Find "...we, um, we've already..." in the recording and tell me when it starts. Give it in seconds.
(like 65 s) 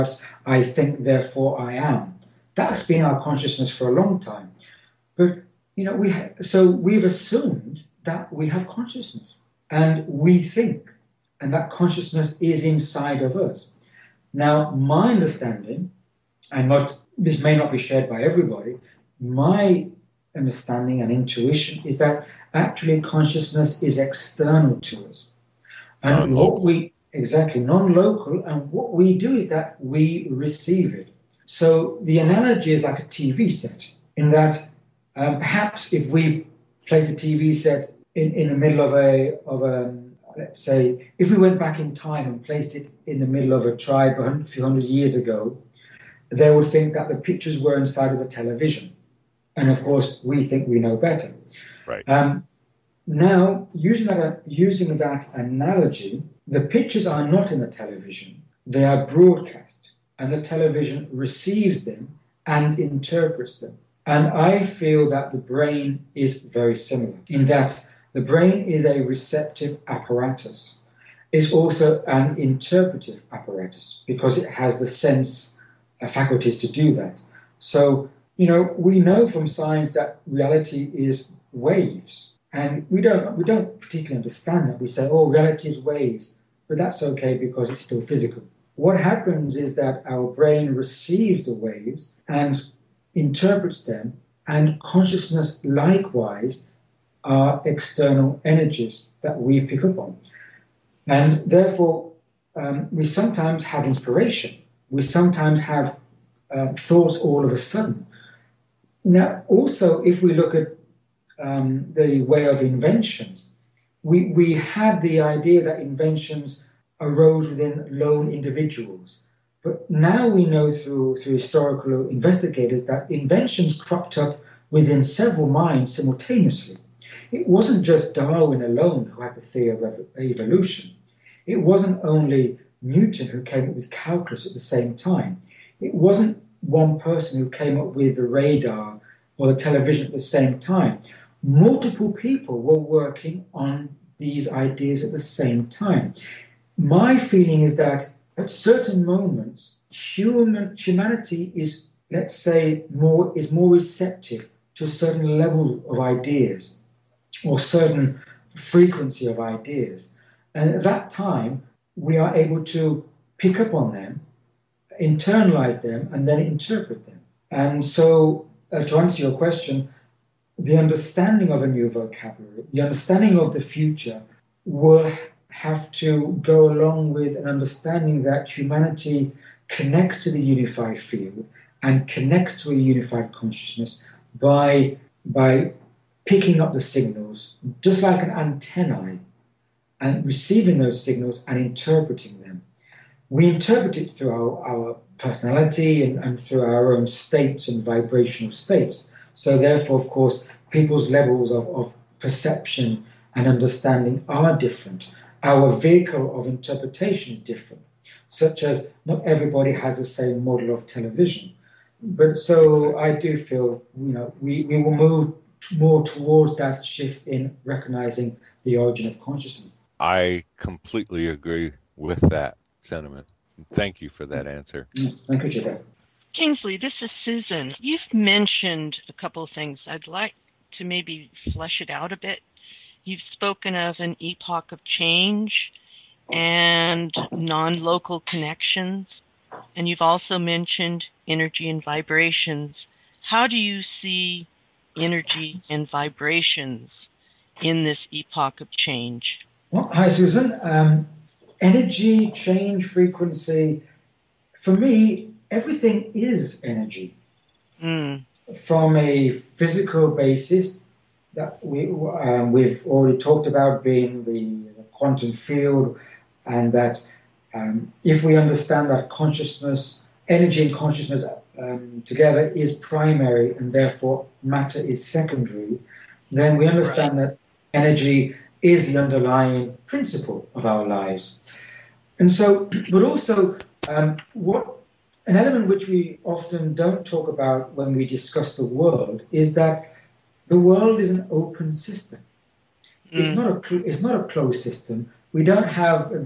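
261 s.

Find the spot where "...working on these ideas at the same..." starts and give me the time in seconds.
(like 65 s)
142 s.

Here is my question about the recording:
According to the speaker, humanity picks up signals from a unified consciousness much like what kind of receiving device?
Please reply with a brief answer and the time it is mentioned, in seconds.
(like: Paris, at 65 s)
antennae, at 188 s.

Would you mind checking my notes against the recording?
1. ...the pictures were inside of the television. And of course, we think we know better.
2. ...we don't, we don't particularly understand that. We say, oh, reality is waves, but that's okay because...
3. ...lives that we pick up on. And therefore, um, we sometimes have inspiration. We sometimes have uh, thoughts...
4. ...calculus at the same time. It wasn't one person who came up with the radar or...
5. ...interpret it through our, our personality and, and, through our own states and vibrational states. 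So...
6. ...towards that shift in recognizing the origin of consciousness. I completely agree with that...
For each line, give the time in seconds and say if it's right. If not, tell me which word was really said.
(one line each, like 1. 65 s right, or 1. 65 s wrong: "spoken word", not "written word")
1. 47 s right
2. 82 s right
3. 98 s wrong: "energies", not "lives"
4. 133 s right
5. 193 s right
6. 216 s right.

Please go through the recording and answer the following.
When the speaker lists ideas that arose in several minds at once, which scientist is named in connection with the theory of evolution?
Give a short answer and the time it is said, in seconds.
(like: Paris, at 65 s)
Darwin, at 128 s.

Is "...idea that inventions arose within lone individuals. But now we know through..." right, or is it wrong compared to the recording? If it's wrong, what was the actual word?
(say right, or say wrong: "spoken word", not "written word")
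right.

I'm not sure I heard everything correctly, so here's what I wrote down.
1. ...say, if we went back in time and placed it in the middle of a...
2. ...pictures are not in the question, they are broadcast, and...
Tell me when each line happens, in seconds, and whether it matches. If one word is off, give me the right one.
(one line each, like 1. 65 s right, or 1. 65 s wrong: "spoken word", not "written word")
1. 40 s right
2. 56 s wrong: "television", not "question".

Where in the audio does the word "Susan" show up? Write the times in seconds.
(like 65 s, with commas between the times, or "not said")
227 s, 250 s.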